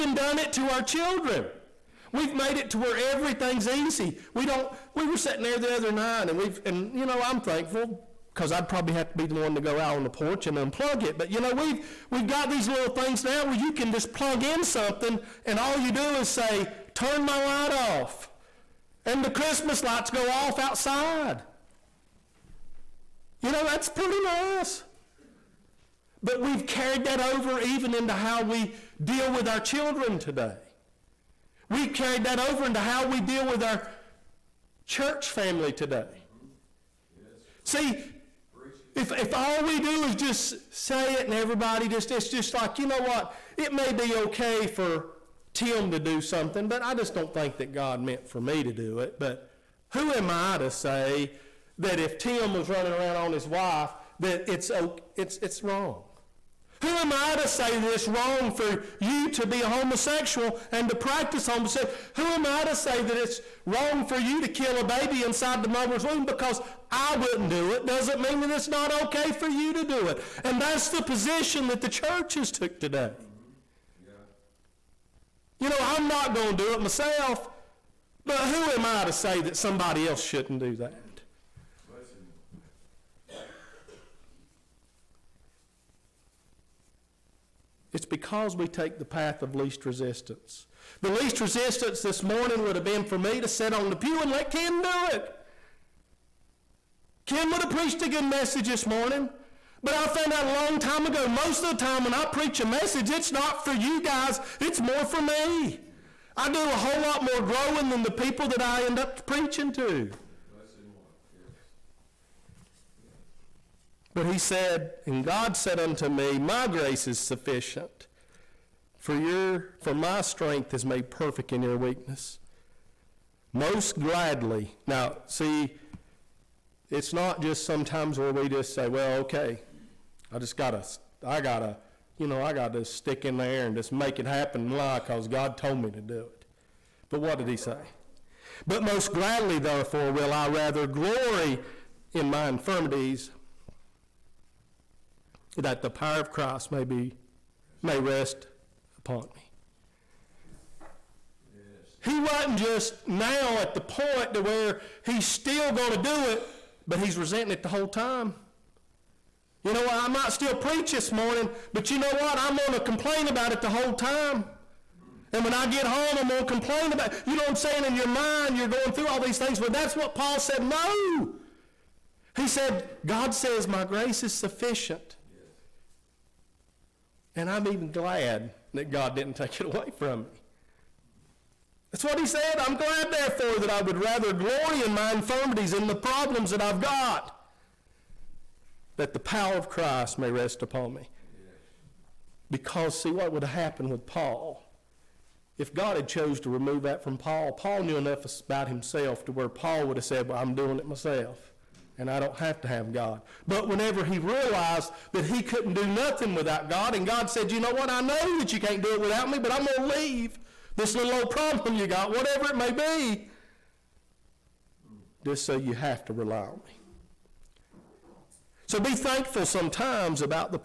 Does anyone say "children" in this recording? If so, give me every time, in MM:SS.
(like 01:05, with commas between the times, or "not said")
00:00, 00:29.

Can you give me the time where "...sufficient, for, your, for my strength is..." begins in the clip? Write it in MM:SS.
01:57.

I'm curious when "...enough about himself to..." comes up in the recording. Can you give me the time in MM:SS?
03:17.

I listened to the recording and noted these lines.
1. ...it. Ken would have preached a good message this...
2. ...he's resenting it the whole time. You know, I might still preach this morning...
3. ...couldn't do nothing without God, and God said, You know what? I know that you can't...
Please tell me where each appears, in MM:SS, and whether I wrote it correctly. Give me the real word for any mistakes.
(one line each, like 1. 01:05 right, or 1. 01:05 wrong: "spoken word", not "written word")
1. 01:35 right
2. 02:36 right
3. 03:25 right.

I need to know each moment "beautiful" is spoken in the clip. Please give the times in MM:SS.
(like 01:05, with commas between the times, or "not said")
not said.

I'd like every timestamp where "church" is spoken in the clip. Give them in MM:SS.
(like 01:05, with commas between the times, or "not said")
00:34, 01:11.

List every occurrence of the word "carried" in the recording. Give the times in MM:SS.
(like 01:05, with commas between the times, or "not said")
00:26, 00:31.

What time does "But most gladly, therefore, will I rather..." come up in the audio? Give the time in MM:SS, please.
02:18.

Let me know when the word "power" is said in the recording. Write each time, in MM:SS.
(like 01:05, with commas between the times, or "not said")
02:25, 03:09.